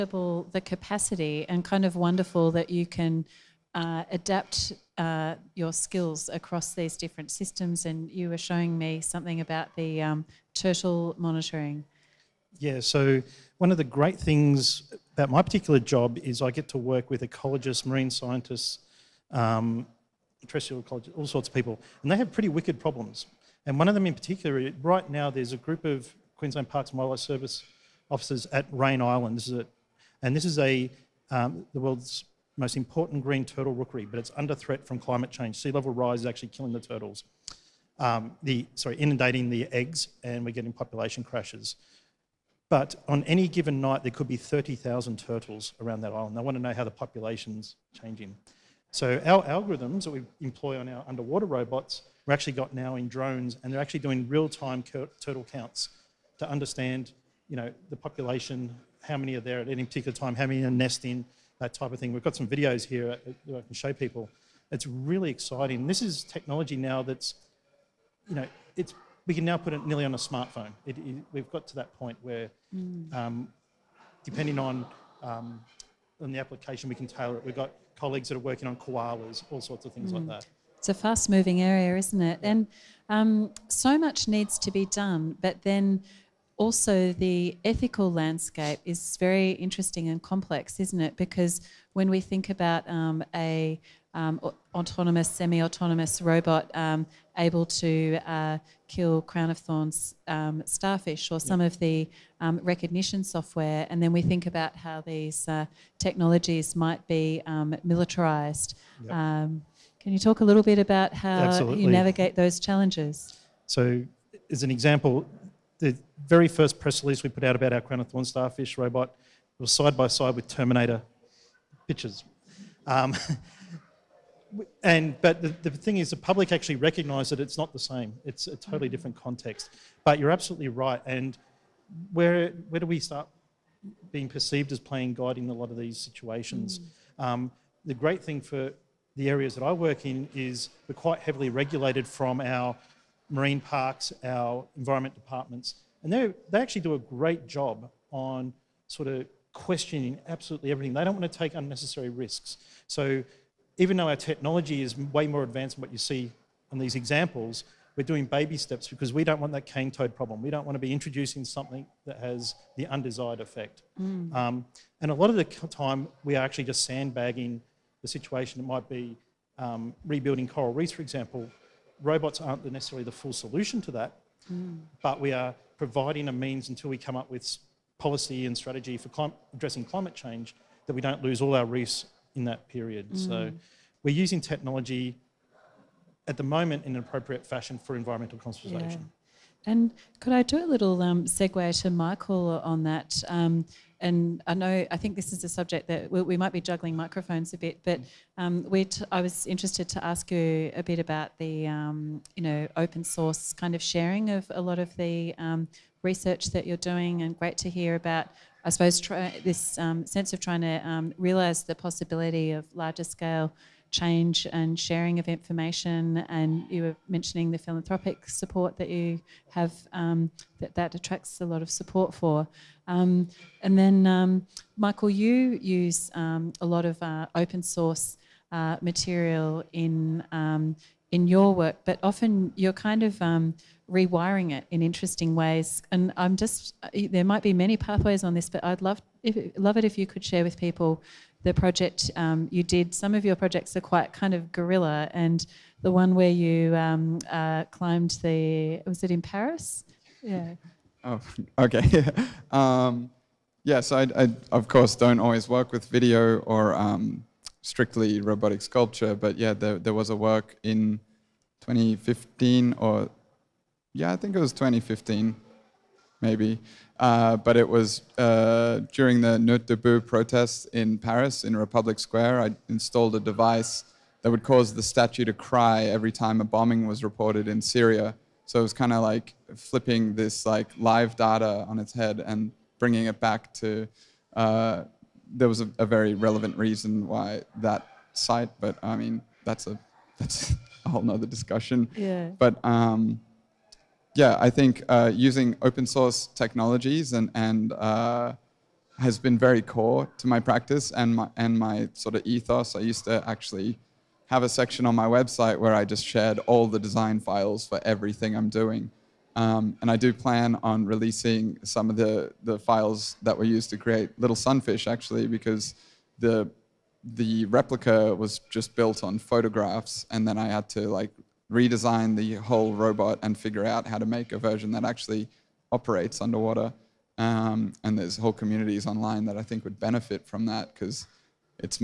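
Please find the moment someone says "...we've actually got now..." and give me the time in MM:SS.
00:52.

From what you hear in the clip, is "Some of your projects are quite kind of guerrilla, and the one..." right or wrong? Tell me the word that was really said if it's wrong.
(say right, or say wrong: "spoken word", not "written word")
right.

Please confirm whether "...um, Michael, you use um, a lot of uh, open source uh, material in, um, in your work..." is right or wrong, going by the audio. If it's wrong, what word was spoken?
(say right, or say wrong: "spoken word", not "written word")
right.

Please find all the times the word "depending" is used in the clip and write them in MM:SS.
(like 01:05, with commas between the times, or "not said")
01:14.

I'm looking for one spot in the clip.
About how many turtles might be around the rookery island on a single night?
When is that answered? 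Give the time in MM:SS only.
00:44.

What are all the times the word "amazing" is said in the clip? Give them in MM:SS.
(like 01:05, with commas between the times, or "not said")
not said.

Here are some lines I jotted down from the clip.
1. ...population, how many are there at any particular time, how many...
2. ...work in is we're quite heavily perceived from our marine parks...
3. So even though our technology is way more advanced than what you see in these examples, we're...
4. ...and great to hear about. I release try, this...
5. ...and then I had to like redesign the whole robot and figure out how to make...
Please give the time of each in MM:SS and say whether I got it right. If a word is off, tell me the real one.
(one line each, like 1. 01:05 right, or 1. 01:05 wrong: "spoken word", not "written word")
1. 00:57 right
2. 02:19 wrong: "regulated", not "perceived"
3. 02:32 right
4. 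03:27 wrong: "suppose", not "release"
5. 05:20 right.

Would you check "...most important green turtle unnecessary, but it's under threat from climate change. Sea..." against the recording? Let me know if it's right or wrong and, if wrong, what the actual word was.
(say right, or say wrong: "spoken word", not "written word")
wrong: "rookery", not "unnecessary".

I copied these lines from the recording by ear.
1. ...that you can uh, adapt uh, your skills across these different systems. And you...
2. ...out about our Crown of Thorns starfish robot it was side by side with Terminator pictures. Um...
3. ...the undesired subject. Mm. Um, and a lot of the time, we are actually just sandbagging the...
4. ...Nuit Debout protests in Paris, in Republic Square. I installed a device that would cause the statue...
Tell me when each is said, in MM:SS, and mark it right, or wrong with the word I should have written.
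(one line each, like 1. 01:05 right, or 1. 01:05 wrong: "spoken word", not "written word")
1. 00:02 right
2. 01:57 right
3. 02:42 wrong: "effect", not "subject"
4. 04:29 right.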